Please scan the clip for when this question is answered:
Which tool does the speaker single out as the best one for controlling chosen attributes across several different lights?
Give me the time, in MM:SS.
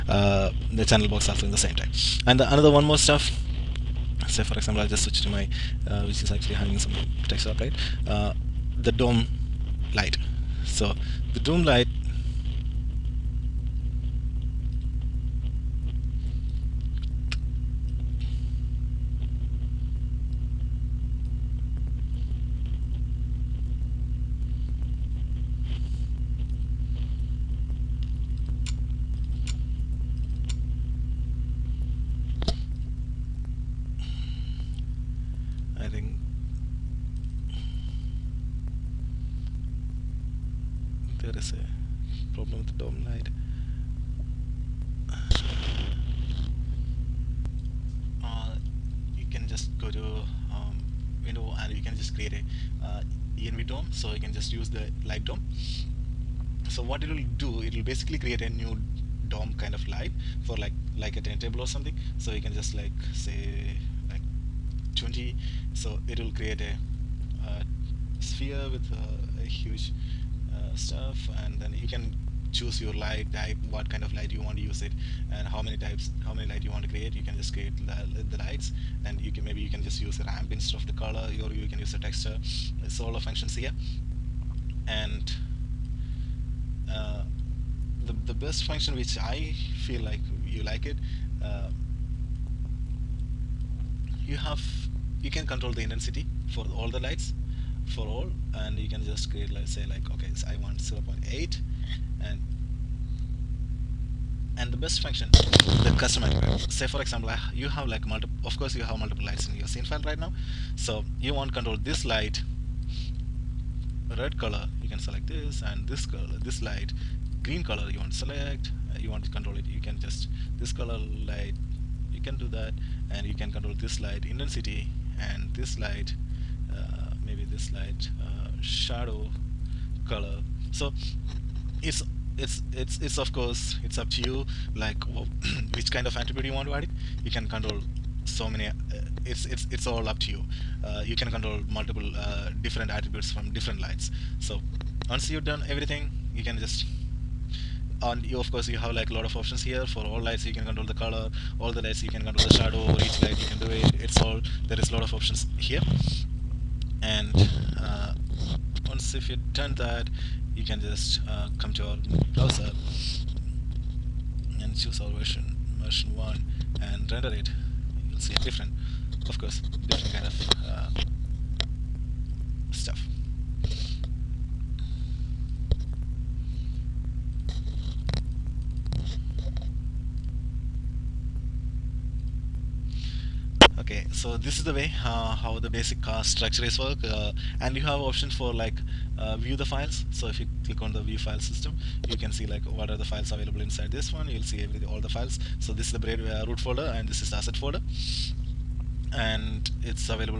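01:45.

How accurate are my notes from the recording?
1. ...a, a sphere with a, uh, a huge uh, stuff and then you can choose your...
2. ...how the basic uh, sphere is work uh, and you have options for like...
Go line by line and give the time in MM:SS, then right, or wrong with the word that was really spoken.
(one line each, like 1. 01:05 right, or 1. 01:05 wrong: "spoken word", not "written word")
1. 01:06 right
2. 03:05 wrong: "structure", not "sphere".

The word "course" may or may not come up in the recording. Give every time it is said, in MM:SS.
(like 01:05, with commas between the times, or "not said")
01:48, 02:13, 02:28, 02:49.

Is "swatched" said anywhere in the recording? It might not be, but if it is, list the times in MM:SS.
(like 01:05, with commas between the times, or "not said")
not said.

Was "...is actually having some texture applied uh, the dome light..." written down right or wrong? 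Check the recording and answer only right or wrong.
right.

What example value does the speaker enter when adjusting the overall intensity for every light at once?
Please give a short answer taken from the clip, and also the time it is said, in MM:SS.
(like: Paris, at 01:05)
0.8, at 01:40.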